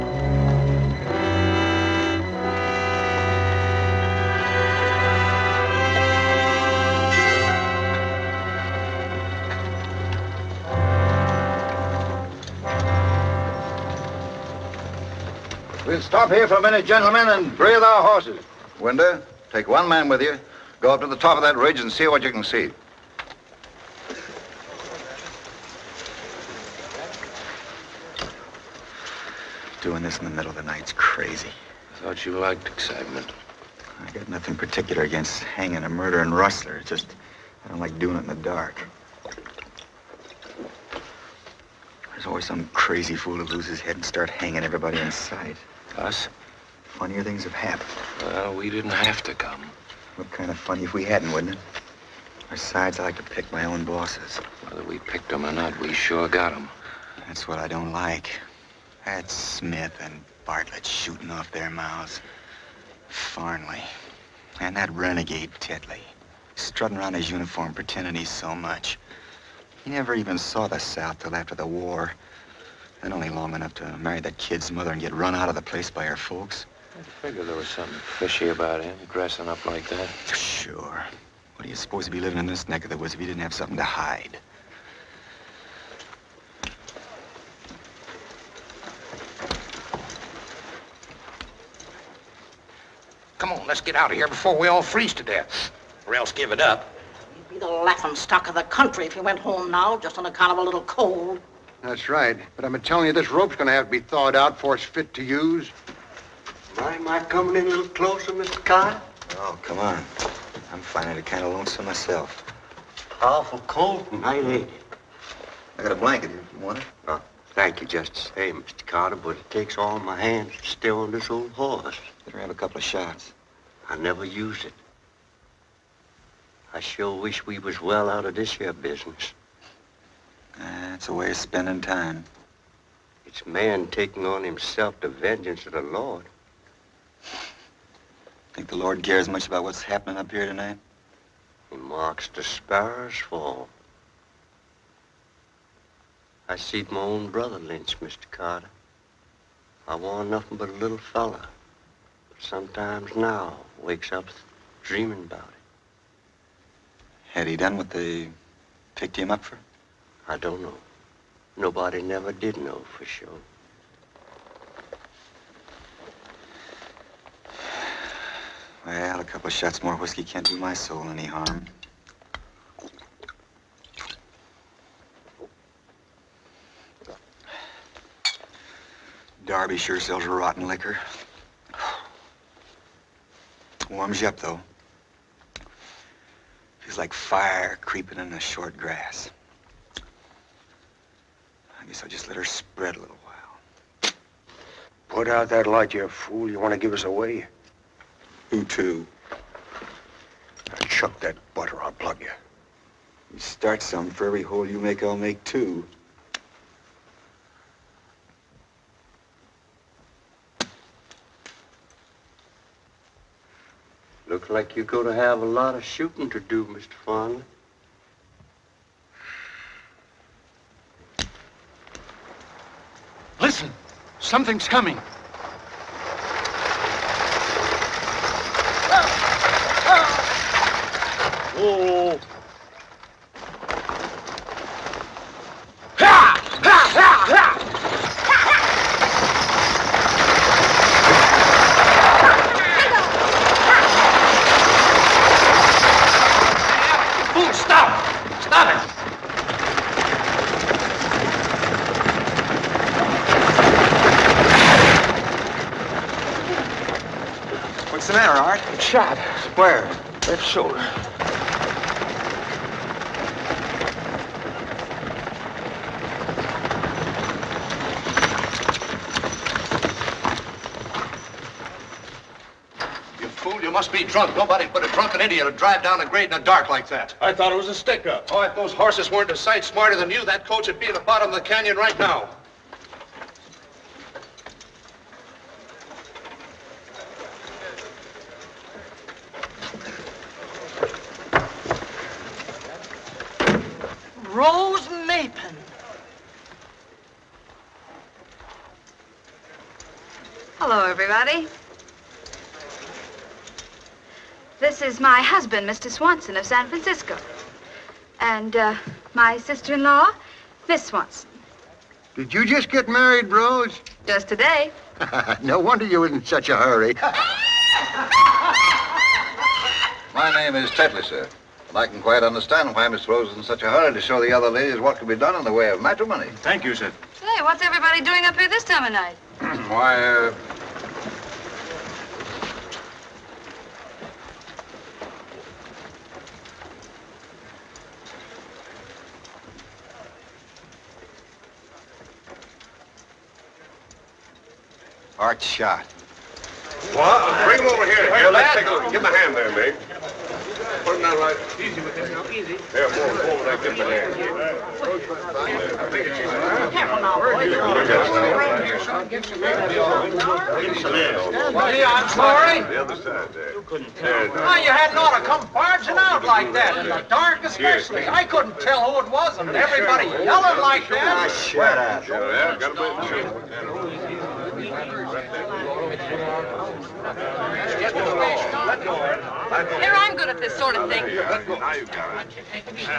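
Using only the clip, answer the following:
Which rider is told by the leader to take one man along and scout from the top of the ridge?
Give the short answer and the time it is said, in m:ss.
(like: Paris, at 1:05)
Winder, at 0:18.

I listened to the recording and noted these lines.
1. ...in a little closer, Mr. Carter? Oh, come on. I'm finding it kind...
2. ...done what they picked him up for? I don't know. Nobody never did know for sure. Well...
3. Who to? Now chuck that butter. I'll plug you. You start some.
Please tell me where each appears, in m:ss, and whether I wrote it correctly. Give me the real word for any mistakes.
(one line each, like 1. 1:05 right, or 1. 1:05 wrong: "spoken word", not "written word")
1. 1:47 right
2. 2:37 right
3. 3:18 right.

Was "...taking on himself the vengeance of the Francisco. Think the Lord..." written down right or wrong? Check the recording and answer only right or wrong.
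wrong.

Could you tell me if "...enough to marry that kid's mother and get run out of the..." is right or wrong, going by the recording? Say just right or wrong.
right.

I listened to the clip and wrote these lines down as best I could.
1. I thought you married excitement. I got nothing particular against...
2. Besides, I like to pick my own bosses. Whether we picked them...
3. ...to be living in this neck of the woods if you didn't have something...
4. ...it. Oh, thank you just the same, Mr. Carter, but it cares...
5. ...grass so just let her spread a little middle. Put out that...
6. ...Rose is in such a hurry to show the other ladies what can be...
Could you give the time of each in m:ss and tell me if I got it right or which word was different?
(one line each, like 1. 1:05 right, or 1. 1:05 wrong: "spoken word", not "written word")
1. 0:31 wrong: "liked", not "married"
2. 0:52 right
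3. 1:22 right
4. 1:56 wrong: "takes", not "cares"
5. 3:08 wrong: "while", not "middle"
6. 5:23 right.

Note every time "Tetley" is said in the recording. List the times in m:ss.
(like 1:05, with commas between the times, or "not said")
1:05, 5:20.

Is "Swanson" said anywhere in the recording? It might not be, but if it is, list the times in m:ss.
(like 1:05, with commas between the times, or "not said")
5:05, 5:10.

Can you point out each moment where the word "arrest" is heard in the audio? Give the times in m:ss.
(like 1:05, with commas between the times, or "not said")
not said.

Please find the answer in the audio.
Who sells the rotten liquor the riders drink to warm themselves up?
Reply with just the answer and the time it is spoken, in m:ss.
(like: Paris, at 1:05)
Darby, at 2:59.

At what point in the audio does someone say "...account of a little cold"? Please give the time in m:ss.
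1:40.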